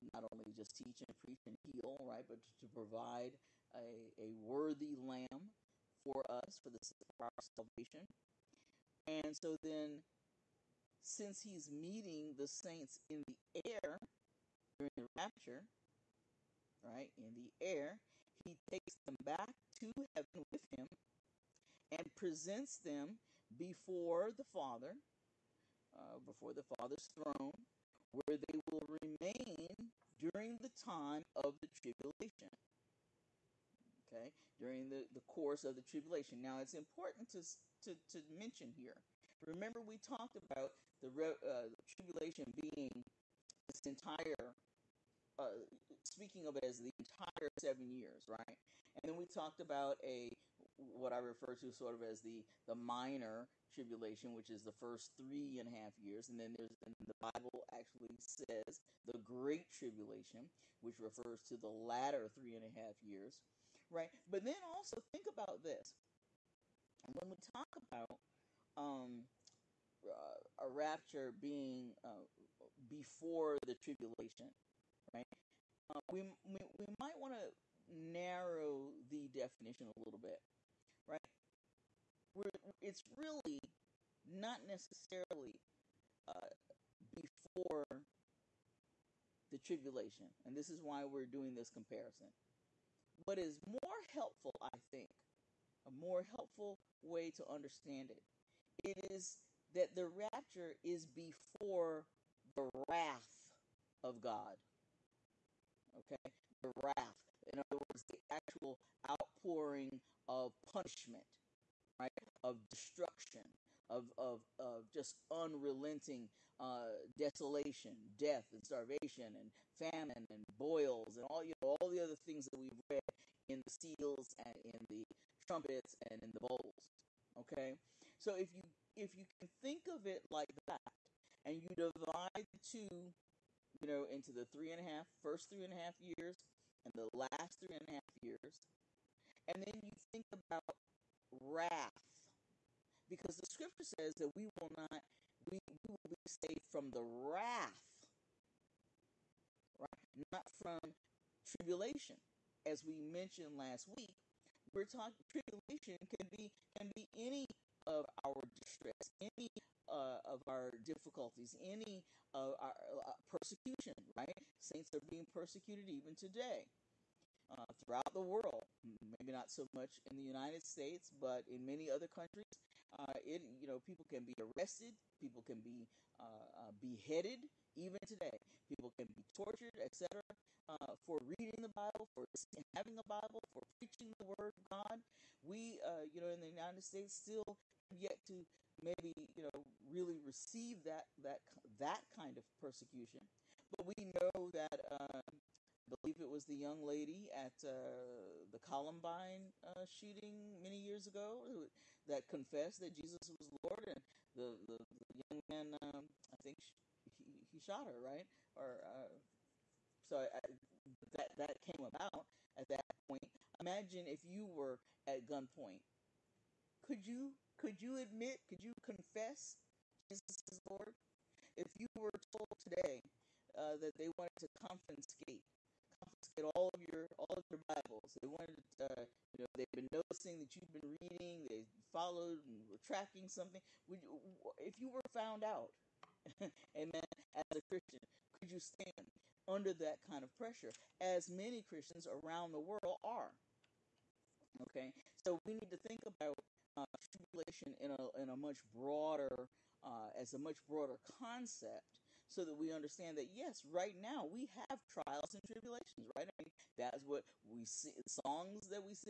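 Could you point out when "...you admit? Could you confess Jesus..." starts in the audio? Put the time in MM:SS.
03:37.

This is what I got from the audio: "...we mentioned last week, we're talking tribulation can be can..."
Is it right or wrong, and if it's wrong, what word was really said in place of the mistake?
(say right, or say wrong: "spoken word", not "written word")
right.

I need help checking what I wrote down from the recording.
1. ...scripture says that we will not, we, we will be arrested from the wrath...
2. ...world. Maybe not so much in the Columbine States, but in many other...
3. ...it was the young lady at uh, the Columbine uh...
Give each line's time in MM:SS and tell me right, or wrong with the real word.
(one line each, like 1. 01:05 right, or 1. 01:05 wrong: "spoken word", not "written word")
1. 02:23 wrong: "saved", not "arrested"
2. 02:48 wrong: "United", not "Columbine"
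3. 03:16 right.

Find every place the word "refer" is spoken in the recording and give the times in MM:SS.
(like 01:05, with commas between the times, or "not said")
00:51, 01:00.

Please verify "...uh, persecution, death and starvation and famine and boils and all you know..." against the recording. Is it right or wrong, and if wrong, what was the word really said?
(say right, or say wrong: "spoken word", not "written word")
wrong: "desolation", not "persecution".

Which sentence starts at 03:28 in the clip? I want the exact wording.
Or uh, so I, that that came about at that point.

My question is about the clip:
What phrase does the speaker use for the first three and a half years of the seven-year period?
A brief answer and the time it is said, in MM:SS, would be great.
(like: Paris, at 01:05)
The minor tribulation, at 00:52.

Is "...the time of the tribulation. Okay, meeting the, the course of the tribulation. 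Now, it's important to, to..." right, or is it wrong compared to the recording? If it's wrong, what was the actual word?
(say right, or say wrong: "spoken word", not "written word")
wrong: "during", not "meeting".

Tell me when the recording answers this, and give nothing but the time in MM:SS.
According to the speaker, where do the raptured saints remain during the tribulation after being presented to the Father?
00:26.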